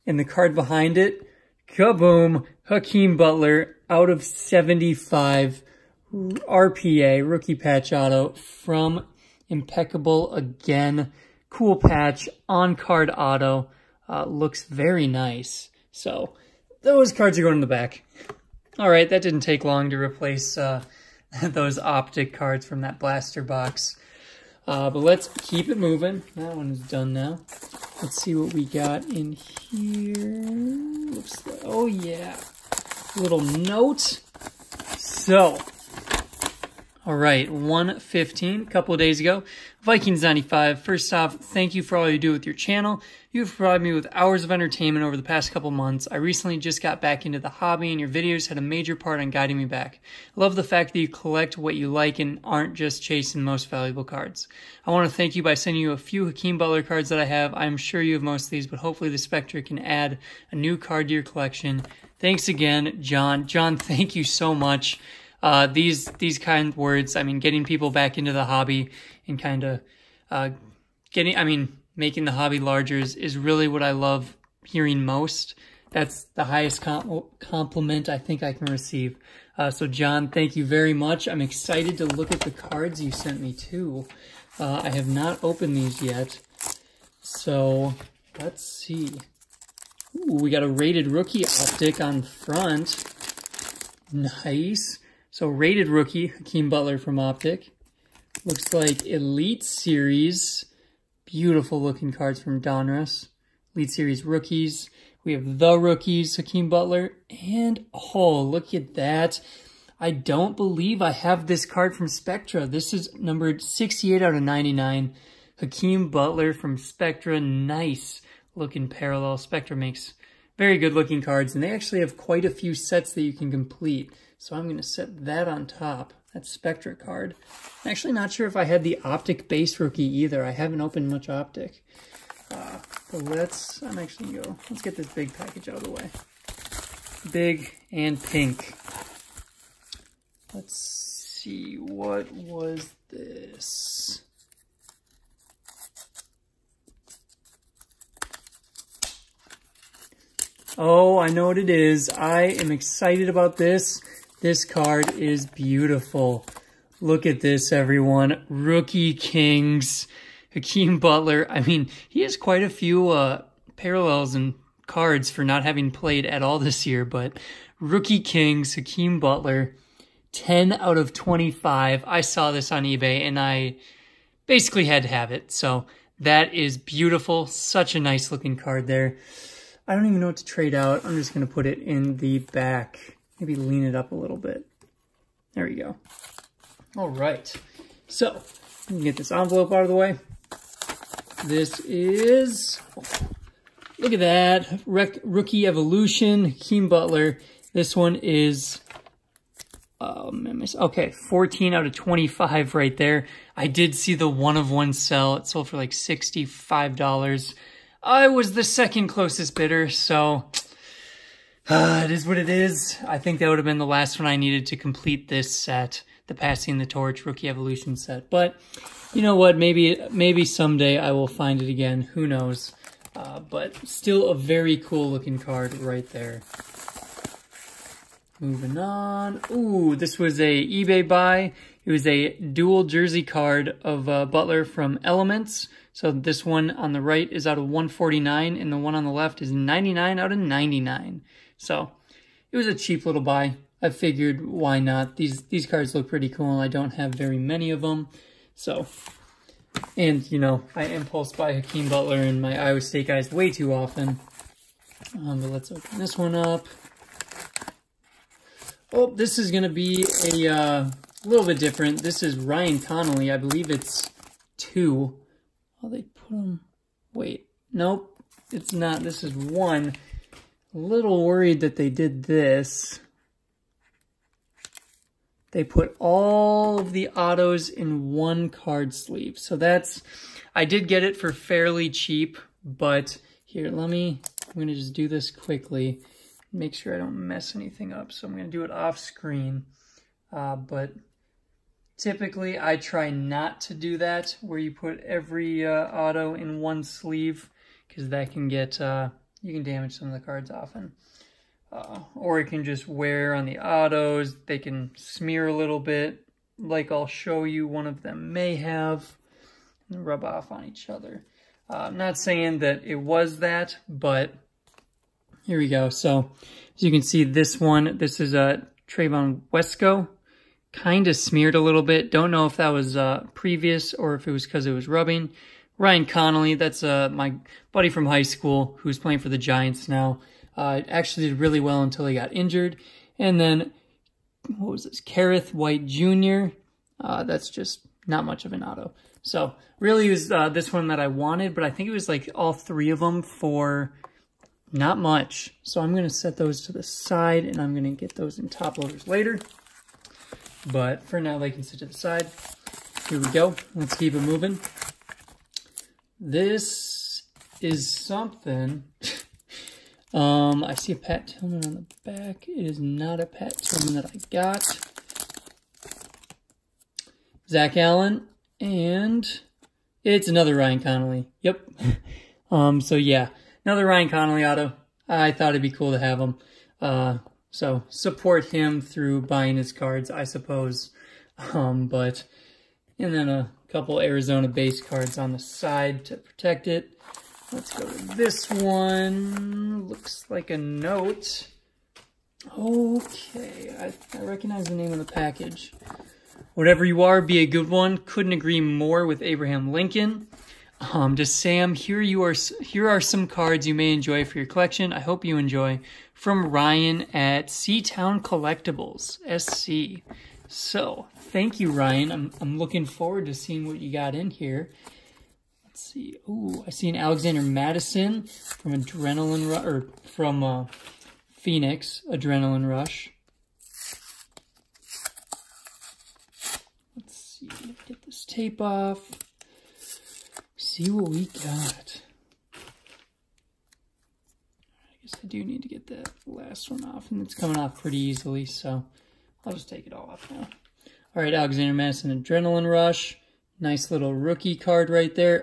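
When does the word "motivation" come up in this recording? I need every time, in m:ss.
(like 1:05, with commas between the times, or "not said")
not said.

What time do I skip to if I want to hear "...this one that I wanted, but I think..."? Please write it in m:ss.
5:40.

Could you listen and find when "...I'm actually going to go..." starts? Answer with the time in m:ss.
2:13.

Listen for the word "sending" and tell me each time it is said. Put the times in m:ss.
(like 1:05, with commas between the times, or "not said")
0:55.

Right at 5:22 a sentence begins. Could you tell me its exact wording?
Don't know if that was uh, previous or if it was because it was rubbing.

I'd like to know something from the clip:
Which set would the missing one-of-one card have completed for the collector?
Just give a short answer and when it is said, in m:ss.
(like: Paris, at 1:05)
Passing the Torch Rookie Evolution, at 3:36.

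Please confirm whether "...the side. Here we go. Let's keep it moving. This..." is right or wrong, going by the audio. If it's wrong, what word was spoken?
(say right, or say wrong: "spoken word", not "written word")
right.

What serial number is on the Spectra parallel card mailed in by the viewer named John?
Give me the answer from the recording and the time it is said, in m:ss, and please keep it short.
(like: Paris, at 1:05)
68/99, at 1:53.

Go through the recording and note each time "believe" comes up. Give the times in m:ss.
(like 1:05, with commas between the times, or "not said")
1:50, 4:23.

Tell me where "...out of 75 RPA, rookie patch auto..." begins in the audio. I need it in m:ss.
0:03.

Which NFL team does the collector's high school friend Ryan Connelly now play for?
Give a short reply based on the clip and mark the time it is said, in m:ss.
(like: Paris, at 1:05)
Giants, at 5:29.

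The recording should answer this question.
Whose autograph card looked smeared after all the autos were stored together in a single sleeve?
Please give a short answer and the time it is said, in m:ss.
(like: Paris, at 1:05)
Trevon Wesco, at 5:18.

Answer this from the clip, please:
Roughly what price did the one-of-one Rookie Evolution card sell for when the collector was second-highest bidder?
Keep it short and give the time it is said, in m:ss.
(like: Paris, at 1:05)
$65, at 3:25.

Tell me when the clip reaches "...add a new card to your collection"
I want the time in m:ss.
0:59.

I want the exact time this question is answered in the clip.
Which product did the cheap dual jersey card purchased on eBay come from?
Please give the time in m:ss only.
3:55.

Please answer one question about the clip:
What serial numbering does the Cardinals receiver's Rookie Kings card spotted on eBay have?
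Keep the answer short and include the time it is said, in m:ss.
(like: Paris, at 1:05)
10/25, at 2:50.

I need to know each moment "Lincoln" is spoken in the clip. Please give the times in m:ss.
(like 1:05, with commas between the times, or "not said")
6:39.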